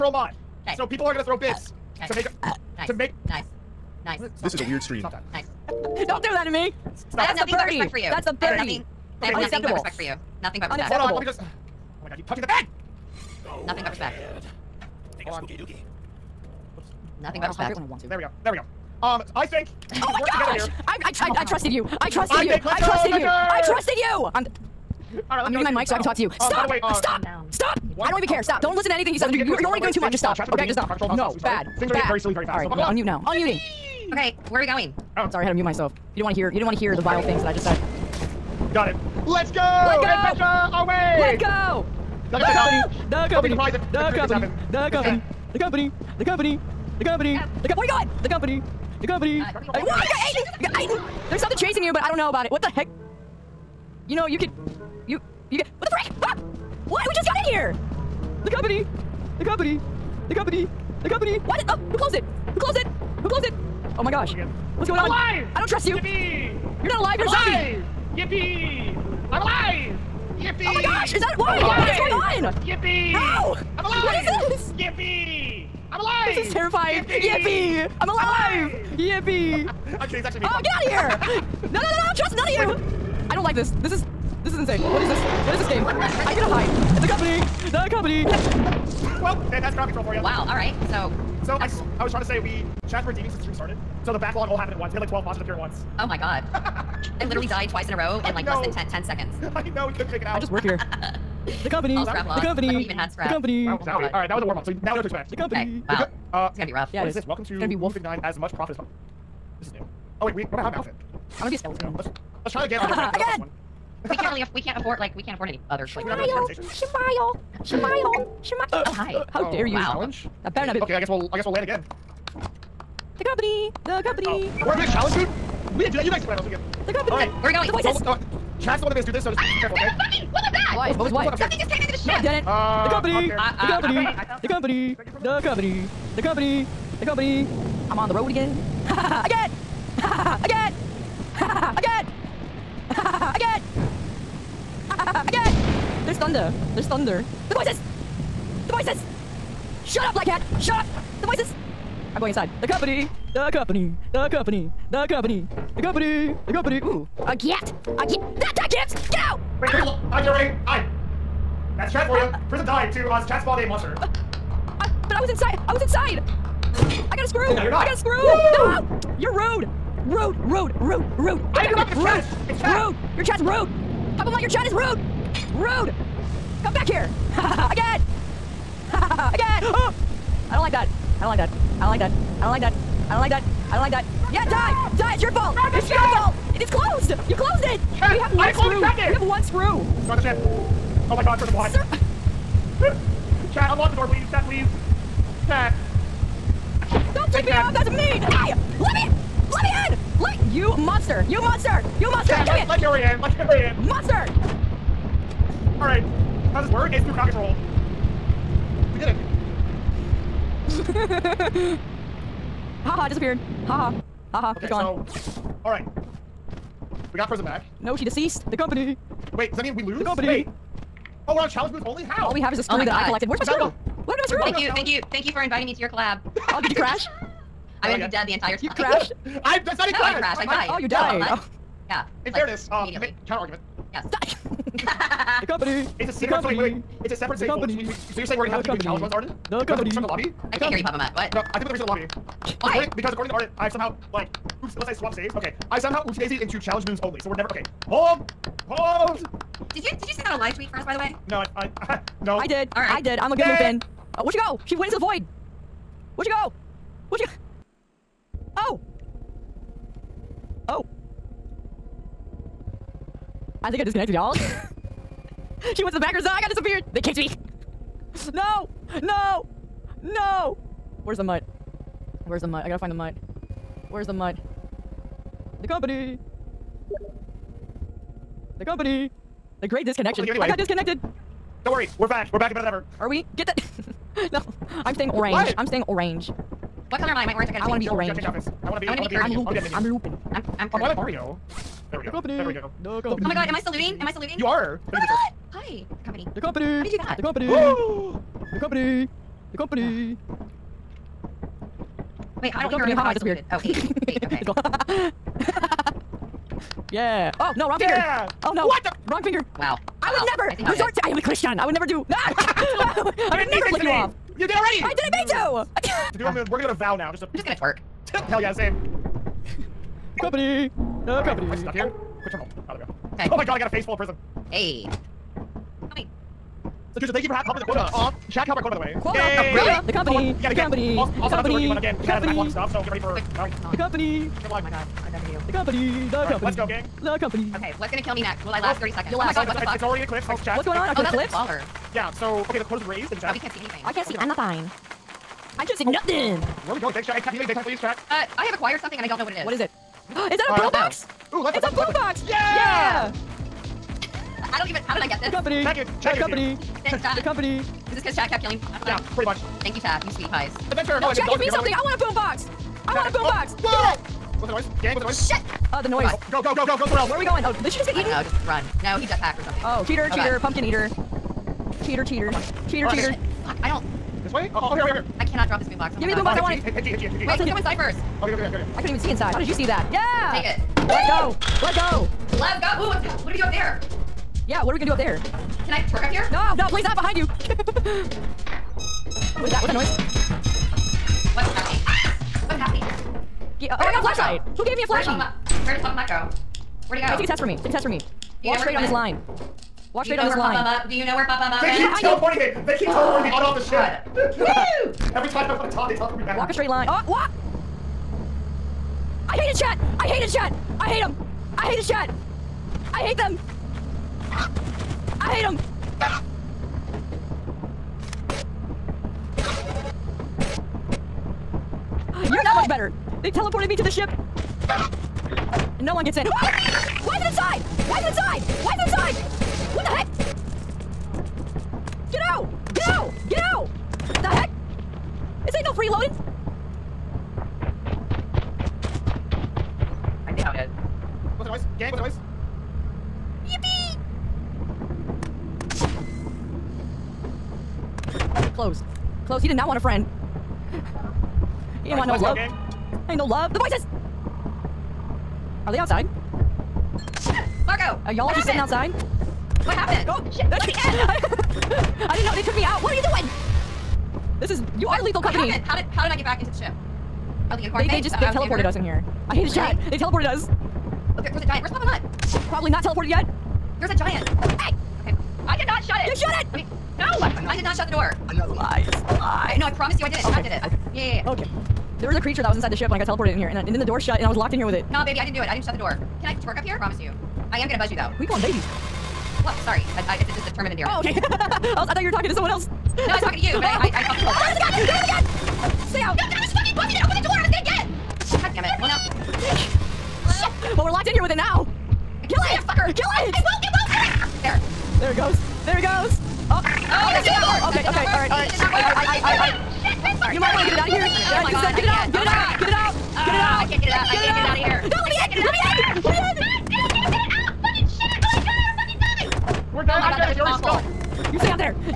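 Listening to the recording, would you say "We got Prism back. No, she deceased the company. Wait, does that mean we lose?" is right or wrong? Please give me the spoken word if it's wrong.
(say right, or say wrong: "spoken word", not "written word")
right.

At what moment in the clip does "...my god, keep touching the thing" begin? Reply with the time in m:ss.
0:12.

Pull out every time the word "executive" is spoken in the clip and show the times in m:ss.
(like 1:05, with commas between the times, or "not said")
not said.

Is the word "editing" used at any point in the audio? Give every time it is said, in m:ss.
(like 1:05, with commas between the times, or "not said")
not said.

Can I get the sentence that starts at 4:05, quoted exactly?
Okay, I somehow oopsie daisyed into challenge moons only.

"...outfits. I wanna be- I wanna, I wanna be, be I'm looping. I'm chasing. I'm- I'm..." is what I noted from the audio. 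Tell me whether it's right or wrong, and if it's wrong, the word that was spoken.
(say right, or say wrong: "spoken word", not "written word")
wrong: "looping", not "chasing".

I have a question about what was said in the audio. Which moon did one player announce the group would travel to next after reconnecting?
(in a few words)
Vow.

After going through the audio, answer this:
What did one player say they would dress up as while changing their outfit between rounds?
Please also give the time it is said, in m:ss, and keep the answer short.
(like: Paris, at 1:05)
a skeleton, at 1:51.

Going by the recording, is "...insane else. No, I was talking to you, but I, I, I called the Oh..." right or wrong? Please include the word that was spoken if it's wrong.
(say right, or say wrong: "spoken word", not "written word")
wrong: "someone", not "insane".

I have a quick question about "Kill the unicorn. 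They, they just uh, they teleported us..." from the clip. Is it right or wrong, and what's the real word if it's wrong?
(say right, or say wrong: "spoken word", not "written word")
right.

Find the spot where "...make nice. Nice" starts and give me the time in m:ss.
0:02.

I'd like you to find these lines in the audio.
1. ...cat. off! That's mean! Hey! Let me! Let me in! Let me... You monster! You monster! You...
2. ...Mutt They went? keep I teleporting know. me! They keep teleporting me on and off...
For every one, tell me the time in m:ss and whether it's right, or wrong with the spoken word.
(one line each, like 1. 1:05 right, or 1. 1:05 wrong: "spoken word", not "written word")
1. 3:17 right
2. 6:41 right.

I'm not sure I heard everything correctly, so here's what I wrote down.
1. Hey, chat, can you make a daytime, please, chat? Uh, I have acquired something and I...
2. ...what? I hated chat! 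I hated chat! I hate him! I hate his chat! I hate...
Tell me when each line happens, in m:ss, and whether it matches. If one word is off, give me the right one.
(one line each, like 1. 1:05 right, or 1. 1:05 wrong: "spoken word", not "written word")
1. 5:47 right
2. 6:47 right.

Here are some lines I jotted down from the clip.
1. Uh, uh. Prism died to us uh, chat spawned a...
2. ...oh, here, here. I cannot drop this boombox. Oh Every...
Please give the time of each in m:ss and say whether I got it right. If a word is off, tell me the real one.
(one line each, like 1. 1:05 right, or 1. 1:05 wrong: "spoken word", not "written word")
1. 2:42 right
2. 6:14 wrong: "Give", not "Every".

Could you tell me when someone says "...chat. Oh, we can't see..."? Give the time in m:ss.
5:43.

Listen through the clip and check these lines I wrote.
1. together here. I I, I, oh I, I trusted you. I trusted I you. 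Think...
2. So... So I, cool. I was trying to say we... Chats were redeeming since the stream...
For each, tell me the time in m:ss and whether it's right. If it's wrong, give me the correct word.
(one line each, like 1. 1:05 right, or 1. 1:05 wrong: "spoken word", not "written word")
1. 0:20 right
2. 1:30 right.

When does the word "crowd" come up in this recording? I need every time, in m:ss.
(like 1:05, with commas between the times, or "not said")
1:29, 3:27.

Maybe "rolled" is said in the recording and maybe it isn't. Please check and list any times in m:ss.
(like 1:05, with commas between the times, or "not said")
not said.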